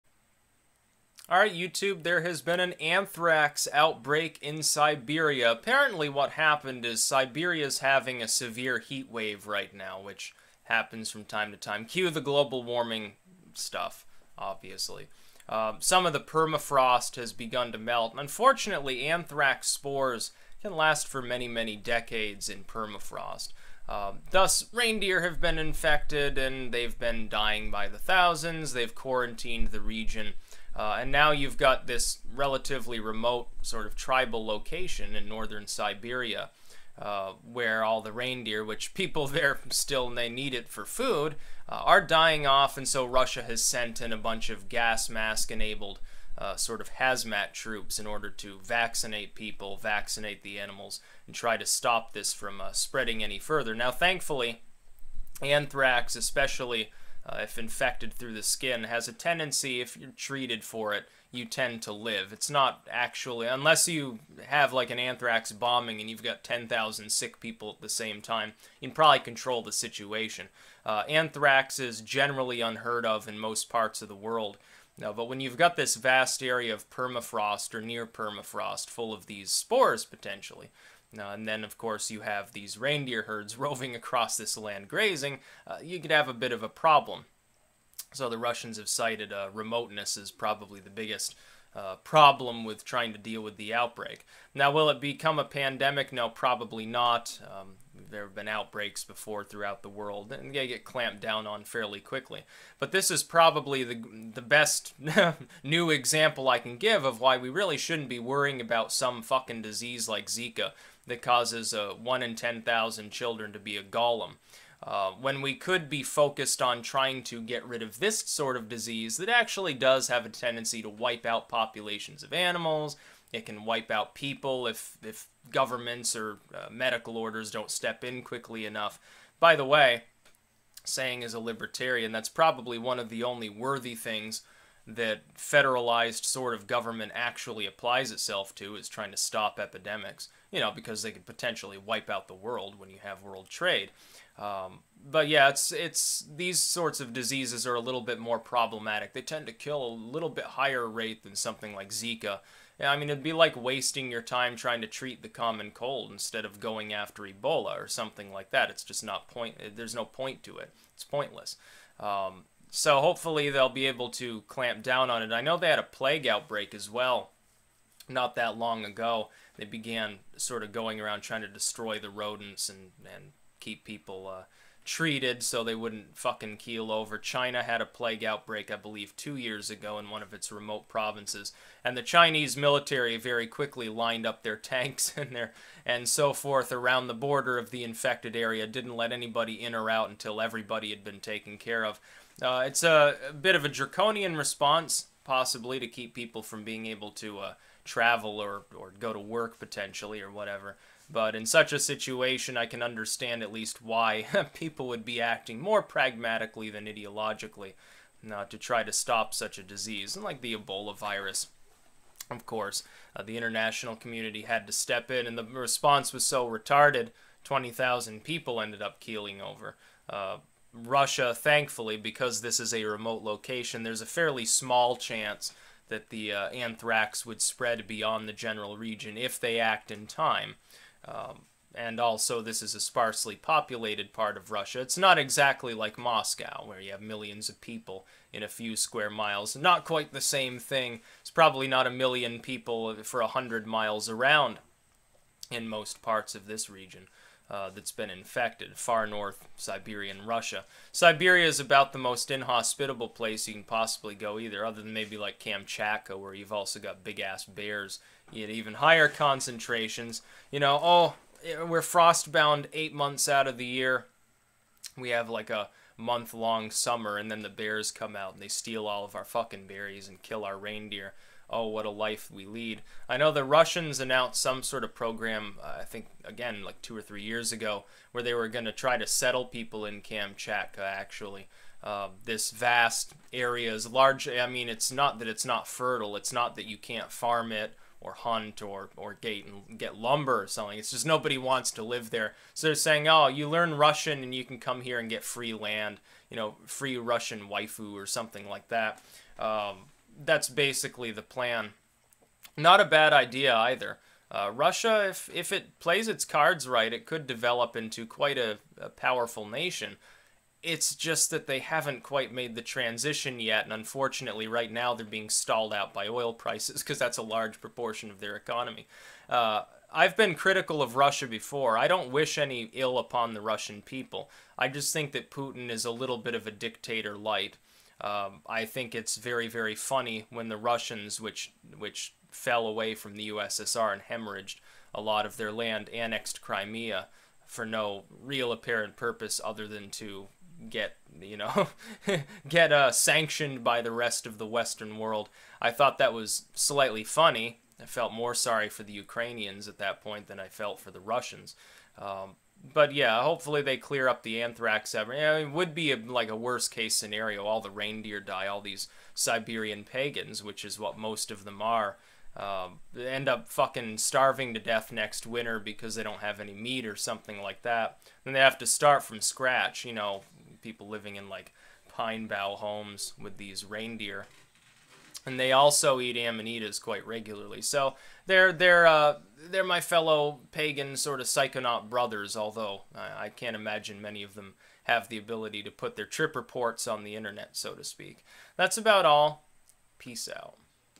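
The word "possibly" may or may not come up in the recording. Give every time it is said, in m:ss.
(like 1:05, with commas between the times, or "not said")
3:15, 4:13.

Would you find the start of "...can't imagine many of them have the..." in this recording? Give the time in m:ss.
6:23.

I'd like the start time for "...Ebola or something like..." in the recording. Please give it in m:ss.
2:37.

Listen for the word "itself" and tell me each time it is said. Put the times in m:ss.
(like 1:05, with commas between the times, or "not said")
2:18.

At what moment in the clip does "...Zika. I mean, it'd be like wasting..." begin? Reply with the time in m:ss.
2:31.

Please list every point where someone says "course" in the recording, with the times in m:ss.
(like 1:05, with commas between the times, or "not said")
1:21, 3:32.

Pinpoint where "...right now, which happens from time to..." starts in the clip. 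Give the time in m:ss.
0:09.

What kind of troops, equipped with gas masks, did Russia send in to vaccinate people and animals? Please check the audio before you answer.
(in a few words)
Hazmat troops.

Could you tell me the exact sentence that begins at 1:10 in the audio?
Uh, anthrax is generally unheard of in most parts of the world.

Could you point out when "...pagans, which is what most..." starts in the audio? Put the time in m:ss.
5:59.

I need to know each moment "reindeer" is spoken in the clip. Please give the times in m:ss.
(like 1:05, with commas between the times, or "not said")
0:24, 0:38, 1:22, 4:30, 5:57, 6:13.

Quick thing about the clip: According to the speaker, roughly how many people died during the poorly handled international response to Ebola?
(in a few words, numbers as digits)
20,000.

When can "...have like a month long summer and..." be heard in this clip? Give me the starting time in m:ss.
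4:25.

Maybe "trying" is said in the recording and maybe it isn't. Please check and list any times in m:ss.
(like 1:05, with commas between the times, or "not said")
1:32, 1:56, 2:18, 2:34, 2:51.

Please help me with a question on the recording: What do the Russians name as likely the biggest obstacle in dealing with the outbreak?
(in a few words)
Remoteness.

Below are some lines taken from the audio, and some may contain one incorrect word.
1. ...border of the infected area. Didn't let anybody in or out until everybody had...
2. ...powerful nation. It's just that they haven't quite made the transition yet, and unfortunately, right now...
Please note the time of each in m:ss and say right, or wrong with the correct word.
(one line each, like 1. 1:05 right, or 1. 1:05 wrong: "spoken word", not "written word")
1. 3:07 right
2. 5:08 right.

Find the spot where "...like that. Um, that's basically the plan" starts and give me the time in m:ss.
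4:58.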